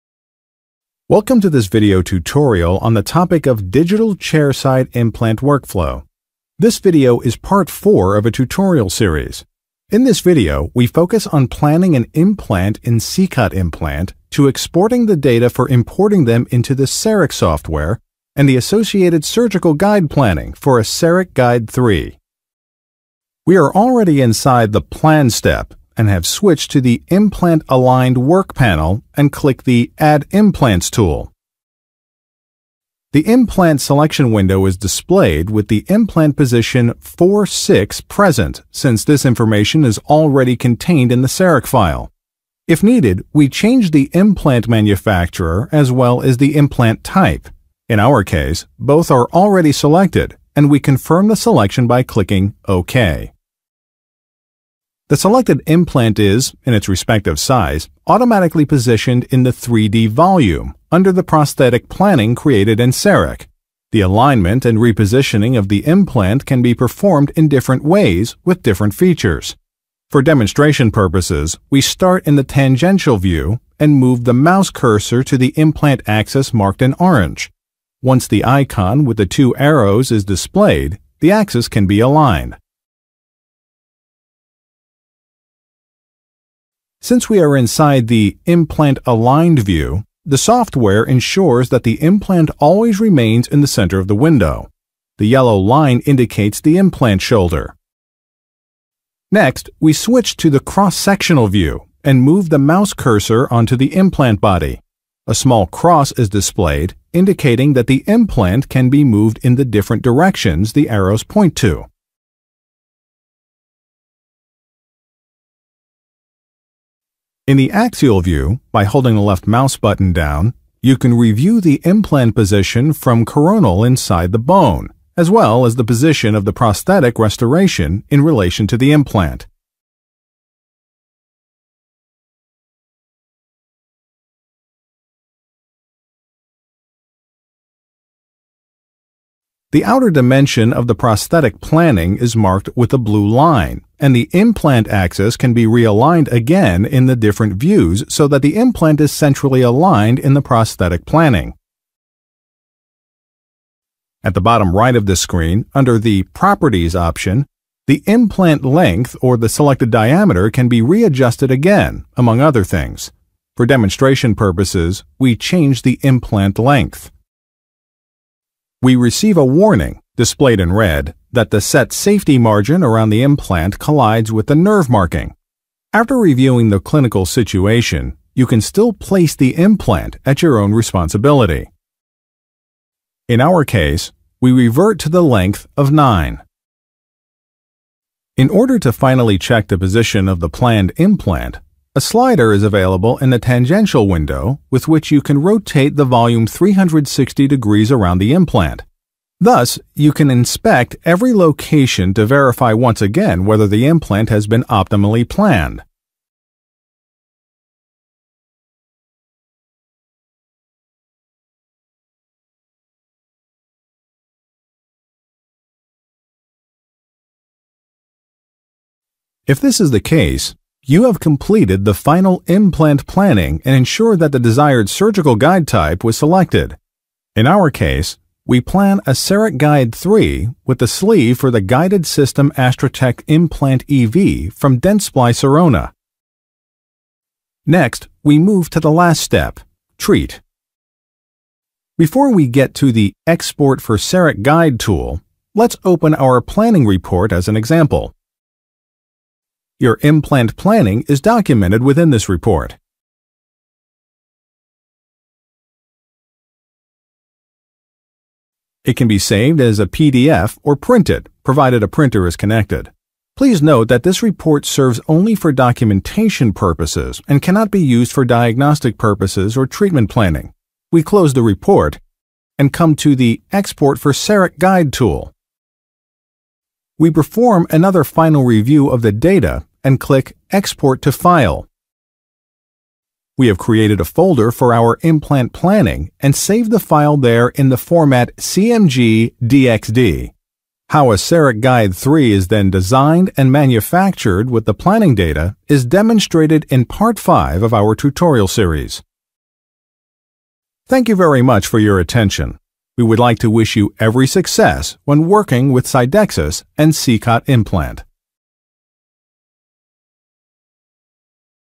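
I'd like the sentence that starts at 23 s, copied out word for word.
We are already inside the plan step and have switched to the Implant Aligned Work panel and click the Add Implants tool.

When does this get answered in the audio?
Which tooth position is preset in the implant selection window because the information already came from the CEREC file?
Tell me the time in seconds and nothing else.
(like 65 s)
36 s.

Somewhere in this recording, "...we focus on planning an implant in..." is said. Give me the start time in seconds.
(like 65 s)
10 s.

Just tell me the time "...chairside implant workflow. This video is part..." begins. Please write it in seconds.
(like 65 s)
4 s.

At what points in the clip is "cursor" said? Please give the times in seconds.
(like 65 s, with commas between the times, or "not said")
74 s, 102 s.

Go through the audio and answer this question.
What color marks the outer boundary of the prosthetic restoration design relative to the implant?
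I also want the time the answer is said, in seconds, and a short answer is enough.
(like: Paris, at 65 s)
Blue, at 142 s.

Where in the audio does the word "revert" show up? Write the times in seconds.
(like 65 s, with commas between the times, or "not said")
184 s.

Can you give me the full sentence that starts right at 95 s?
The yellow line indicates the implant shoulder.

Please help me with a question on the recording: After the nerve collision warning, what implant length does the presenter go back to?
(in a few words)
9.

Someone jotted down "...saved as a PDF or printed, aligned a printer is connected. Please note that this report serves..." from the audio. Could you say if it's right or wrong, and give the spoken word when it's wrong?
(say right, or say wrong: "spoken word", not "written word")
wrong: "provided", not "aligned".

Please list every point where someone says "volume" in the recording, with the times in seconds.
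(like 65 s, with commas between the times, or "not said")
60 s, 196 s.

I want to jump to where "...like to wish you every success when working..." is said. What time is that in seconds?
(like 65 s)
303 s.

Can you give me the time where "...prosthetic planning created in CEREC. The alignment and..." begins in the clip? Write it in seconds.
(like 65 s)
61 s.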